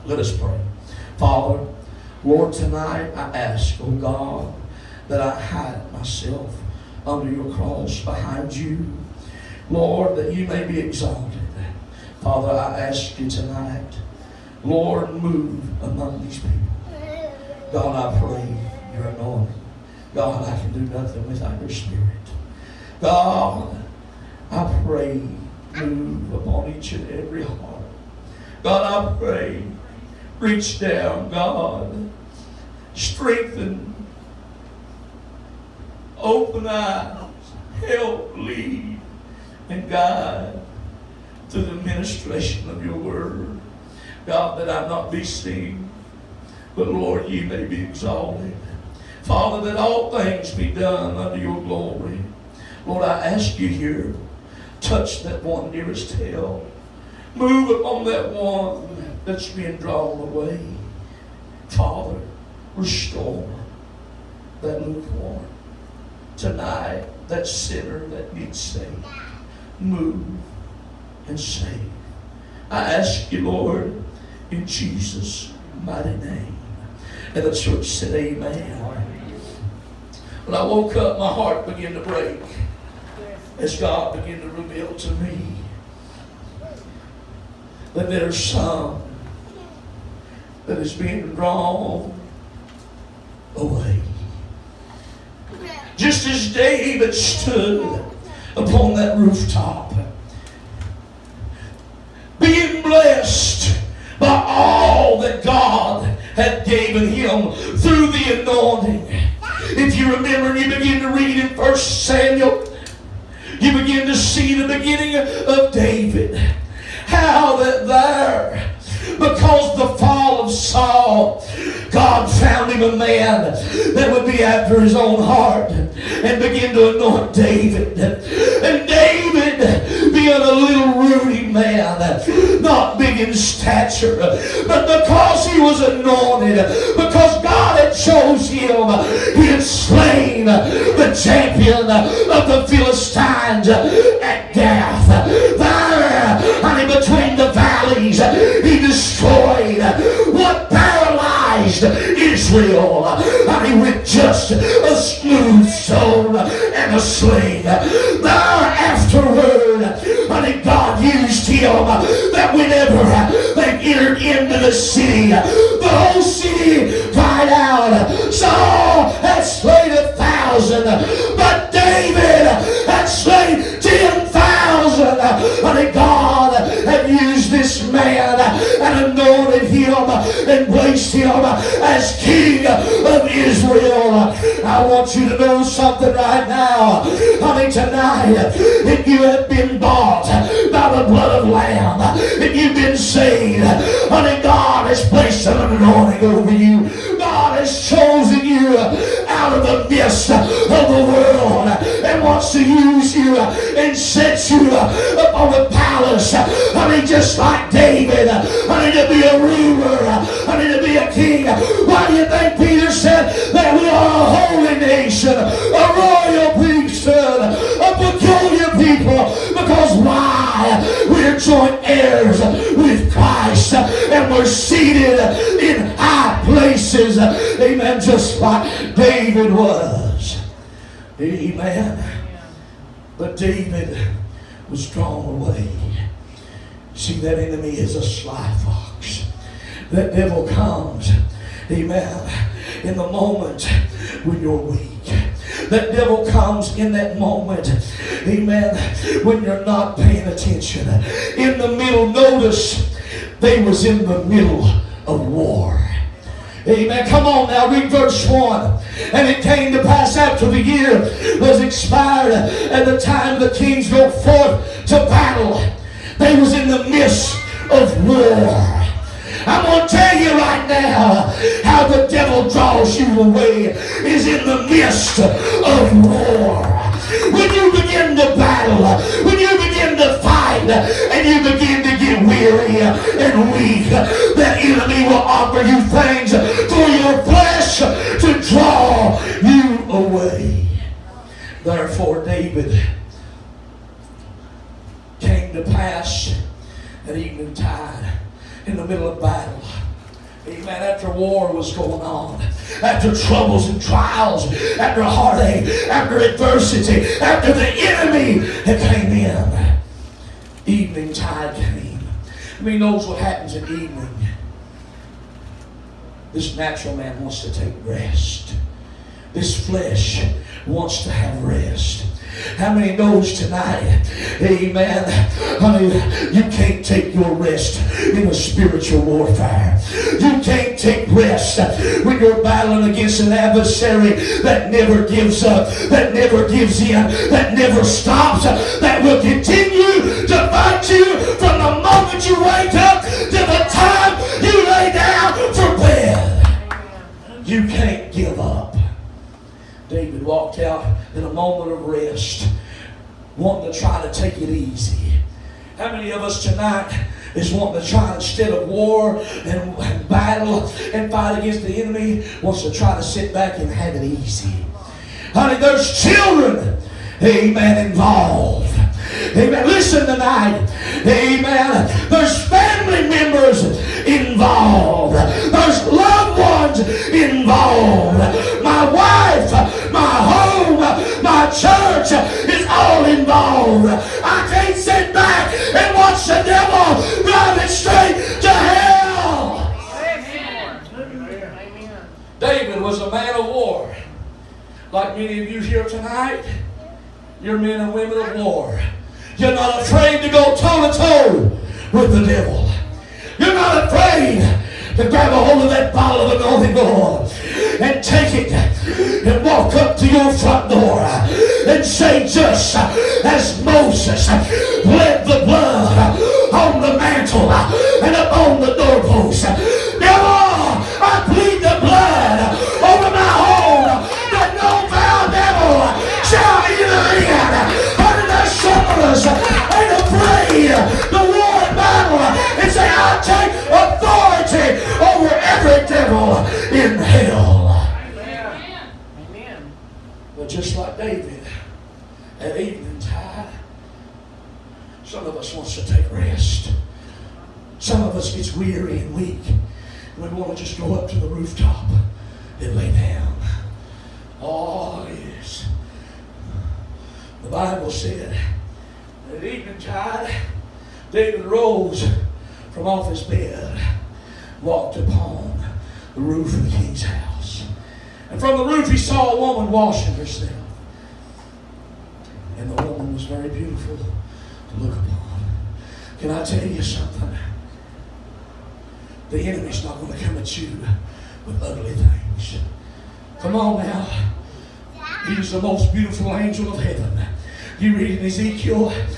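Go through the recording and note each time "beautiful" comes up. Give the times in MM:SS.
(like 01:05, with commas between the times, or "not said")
07:53, 08:05.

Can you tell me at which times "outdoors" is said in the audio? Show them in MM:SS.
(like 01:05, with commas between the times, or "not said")
not said.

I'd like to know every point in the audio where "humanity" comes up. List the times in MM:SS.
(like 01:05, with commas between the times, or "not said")
not said.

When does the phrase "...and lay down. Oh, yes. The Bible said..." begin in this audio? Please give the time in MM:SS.
07:32.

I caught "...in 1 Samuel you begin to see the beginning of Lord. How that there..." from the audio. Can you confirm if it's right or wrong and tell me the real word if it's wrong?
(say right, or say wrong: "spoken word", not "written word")
wrong: "David", not "Lord".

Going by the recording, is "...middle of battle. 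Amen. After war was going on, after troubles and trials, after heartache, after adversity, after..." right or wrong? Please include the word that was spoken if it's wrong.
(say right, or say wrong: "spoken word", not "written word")
right.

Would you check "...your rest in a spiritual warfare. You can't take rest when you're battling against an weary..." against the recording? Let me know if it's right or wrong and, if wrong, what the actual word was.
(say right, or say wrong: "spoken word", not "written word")
wrong: "adversary", not "weary".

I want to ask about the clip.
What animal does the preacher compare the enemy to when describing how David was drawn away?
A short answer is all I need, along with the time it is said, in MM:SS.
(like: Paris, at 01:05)
Sly fox, at 03:58.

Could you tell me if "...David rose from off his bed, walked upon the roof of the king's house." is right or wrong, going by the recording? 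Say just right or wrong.
right.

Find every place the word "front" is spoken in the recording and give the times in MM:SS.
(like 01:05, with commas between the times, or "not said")
06:50.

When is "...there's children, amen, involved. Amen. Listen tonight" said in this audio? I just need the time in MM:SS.
06:05.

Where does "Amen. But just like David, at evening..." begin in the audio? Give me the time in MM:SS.
07:19.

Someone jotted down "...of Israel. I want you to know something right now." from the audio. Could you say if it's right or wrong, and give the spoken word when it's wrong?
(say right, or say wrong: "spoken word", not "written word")
right.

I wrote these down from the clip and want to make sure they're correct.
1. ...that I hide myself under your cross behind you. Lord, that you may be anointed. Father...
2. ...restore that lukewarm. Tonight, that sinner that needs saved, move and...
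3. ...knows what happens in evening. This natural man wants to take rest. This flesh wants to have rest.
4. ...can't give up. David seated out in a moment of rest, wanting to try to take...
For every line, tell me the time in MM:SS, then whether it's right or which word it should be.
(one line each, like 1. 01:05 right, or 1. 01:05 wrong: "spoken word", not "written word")
1. 00:05 wrong: "exalted", not "anointed"
2. 01:02 right
3. 05:12 right
4. 05:47 wrong: "walked", not "seated".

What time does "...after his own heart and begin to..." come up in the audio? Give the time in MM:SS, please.
02:04.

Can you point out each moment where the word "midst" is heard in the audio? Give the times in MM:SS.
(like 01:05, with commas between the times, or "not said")
03:19, 04:26, 04:34.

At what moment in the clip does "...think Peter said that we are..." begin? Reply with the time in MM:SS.
03:32.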